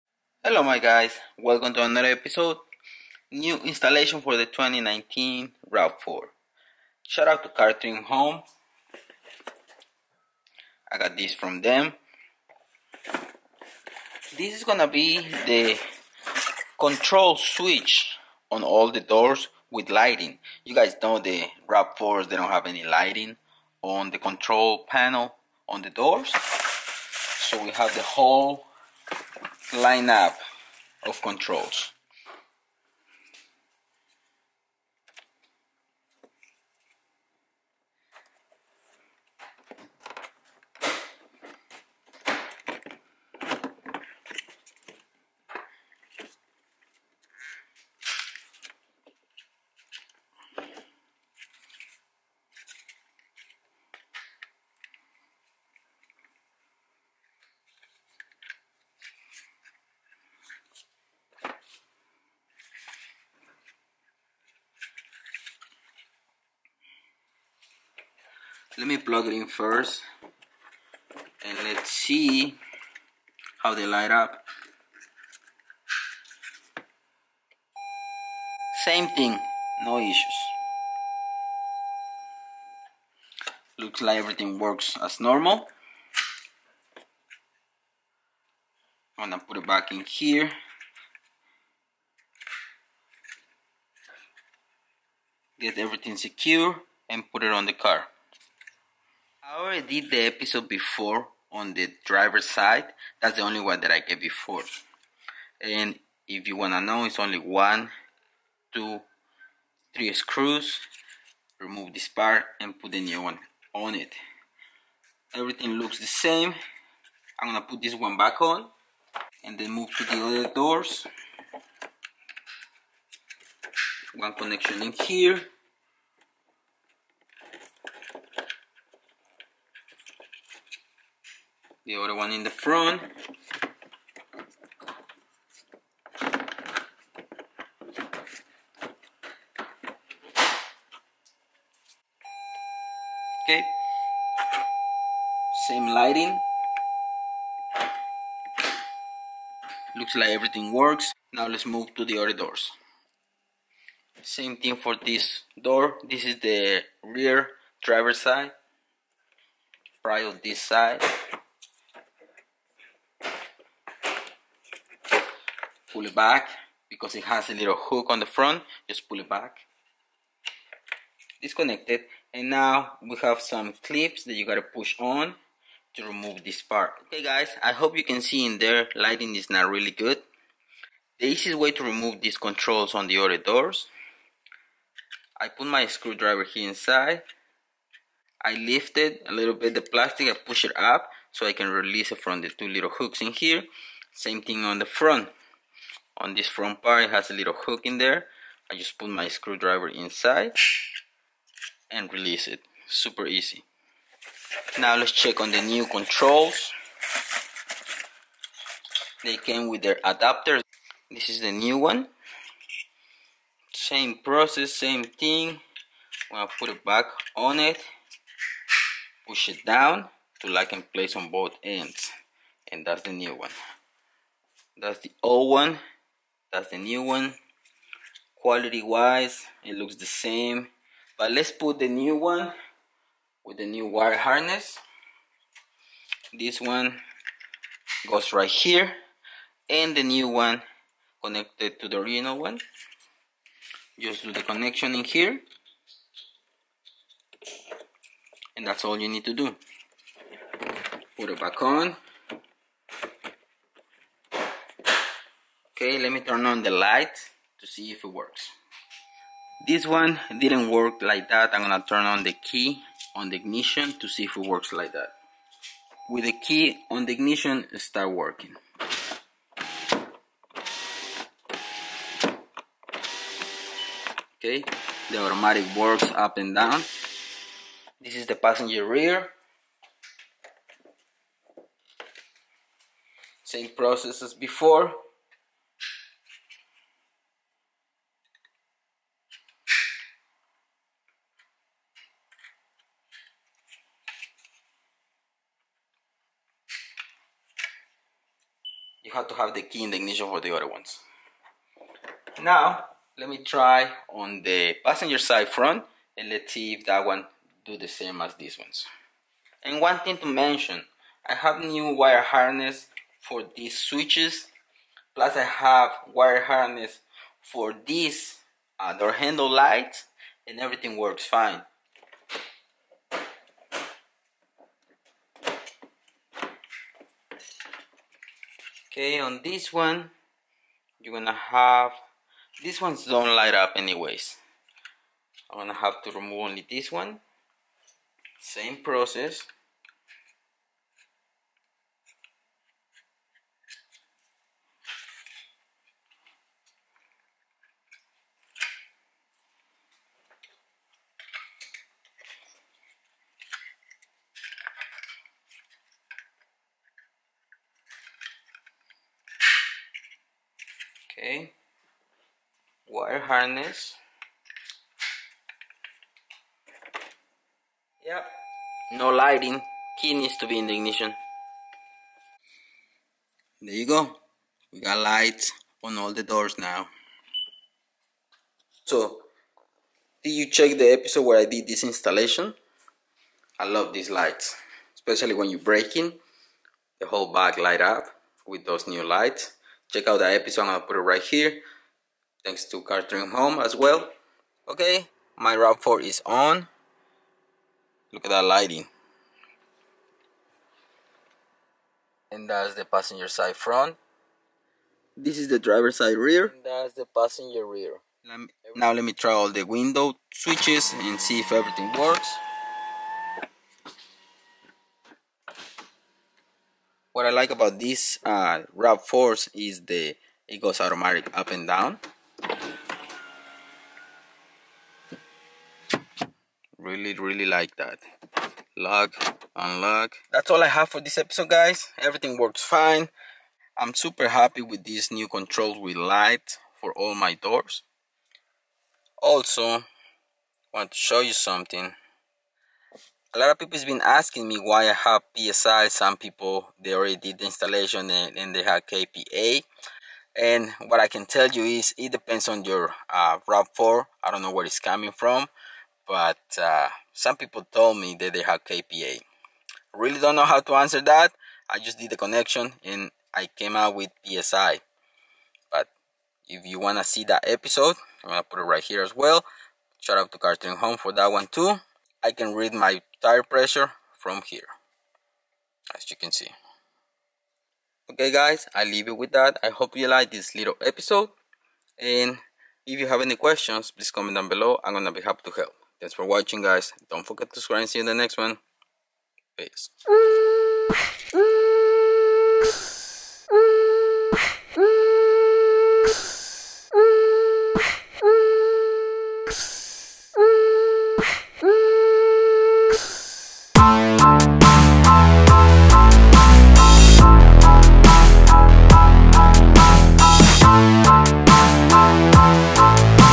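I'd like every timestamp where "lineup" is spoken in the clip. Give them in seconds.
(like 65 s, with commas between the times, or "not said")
29 s.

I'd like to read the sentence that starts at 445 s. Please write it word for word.
Some people they already did the installation and, and they have KPA.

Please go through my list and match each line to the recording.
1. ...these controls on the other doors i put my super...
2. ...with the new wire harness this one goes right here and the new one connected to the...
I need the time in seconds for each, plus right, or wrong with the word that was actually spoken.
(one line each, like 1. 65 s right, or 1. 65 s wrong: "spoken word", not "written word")
1. 182 s wrong: "screwdriver", not "super"
2. 233 s right.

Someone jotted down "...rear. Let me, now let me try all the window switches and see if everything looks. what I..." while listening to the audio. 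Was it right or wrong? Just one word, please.
wrong.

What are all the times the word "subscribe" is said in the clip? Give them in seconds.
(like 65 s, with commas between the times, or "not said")
487 s.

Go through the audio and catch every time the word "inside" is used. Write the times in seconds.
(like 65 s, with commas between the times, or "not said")
186 s, 199 s.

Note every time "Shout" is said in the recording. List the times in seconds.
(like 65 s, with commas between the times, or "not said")
7 s, 470 s.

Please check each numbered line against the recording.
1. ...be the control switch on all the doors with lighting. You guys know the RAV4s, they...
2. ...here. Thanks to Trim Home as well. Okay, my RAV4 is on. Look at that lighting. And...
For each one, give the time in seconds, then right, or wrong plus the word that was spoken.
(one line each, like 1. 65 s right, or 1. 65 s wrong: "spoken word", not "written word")
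1. 14 s right
2. 391 s right.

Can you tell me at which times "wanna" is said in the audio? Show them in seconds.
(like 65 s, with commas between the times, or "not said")
106 s, 466 s.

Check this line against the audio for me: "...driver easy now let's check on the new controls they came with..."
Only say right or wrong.
wrong.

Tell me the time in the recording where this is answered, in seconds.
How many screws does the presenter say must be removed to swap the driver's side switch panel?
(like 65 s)
107 s.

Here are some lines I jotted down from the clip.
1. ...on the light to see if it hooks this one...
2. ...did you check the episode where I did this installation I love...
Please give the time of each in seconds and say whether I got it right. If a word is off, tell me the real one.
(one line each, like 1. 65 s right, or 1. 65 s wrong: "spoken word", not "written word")
1. 256 s wrong: "works", not "hooks"
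2. 380 s right.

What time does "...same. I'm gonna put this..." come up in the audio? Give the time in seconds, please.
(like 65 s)
116 s.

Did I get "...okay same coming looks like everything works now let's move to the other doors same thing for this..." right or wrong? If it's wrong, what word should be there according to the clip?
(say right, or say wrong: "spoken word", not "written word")
wrong: "lighting", not "coming".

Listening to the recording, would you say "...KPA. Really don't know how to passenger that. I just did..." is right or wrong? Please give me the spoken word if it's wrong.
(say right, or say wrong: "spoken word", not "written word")
wrong: "answer", not "passenger".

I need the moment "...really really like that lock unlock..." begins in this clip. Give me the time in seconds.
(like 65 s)
426 s.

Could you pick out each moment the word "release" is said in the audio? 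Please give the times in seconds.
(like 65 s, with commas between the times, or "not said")
191 s, 202 s.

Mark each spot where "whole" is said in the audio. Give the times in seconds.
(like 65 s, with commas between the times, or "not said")
28 s, 387 s.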